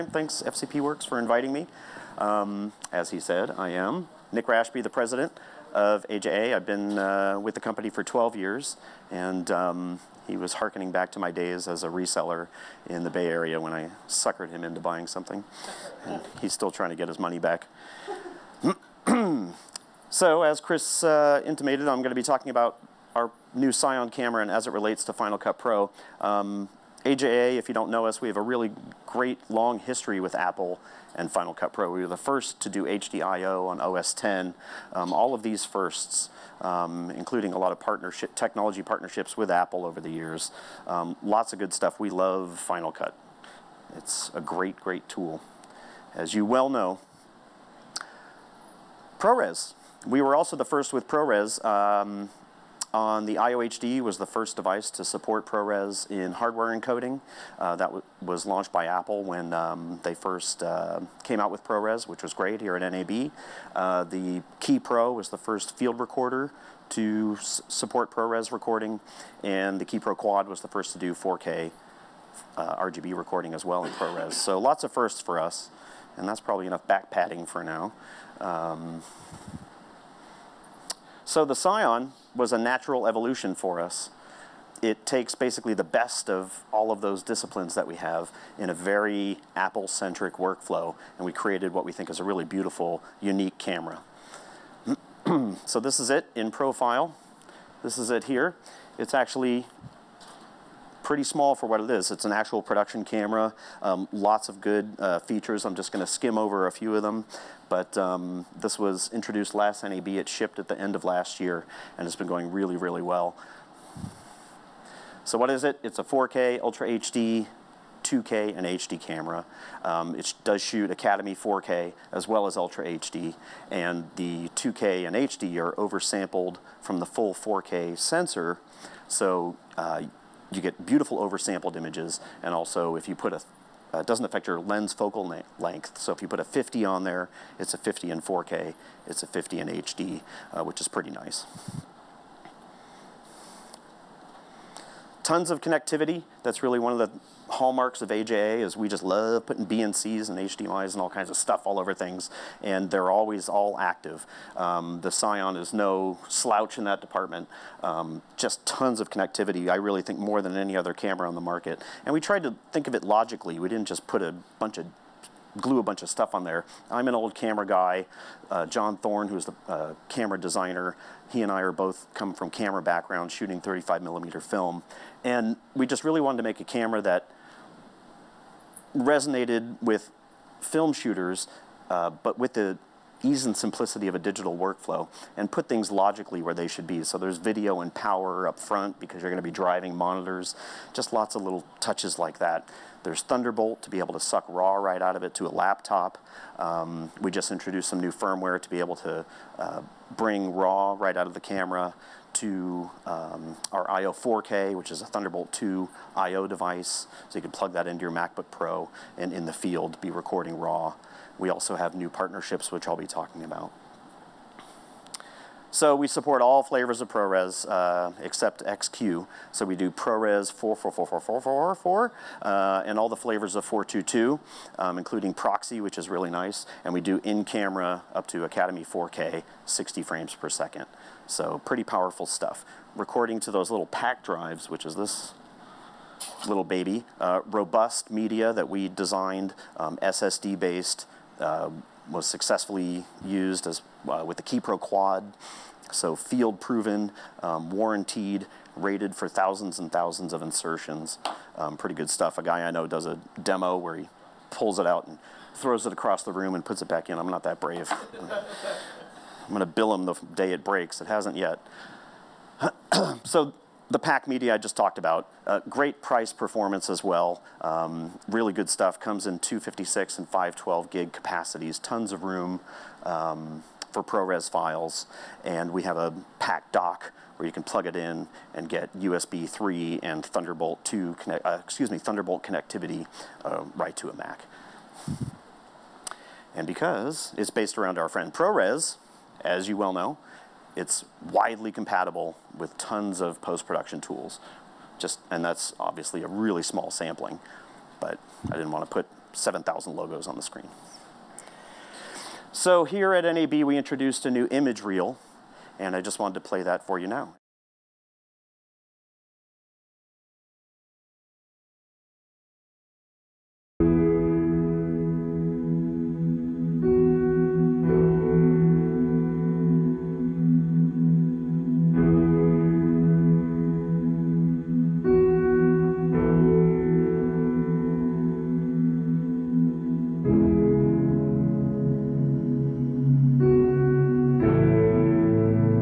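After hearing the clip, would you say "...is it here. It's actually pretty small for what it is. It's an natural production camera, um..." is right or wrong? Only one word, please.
wrong.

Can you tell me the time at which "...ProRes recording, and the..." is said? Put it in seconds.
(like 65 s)
68 s.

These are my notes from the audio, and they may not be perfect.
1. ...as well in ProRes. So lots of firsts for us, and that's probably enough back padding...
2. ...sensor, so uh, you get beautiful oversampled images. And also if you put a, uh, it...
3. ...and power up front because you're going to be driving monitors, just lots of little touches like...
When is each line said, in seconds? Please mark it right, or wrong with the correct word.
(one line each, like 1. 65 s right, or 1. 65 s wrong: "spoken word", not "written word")
1. 73 s right
2. 127 s right
3. 187 s right.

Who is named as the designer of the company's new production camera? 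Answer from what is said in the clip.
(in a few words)
John Thorne.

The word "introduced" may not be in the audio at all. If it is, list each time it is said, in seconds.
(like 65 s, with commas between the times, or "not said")
109 s, 197 s, 303 s.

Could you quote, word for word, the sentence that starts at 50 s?
We were also the first with ProRes.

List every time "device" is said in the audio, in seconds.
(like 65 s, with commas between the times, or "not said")
54 s, 206 s.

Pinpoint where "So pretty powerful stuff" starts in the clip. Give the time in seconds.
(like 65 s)
231 s.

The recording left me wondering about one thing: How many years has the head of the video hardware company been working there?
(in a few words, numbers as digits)
12.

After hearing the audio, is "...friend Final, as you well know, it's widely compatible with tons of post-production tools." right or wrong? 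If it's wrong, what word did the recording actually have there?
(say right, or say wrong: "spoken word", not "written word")
wrong: "ProRes", not "Final".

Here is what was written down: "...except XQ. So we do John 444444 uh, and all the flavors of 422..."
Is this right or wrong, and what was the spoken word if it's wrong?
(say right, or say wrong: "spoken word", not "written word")
wrong: "ProRes", not "John".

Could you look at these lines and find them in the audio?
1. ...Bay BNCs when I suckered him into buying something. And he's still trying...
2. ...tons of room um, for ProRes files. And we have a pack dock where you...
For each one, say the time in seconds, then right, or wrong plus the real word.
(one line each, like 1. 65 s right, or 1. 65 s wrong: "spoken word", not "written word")
1. 13 s wrong: "Area", not "BNCs"
2. 271 s right.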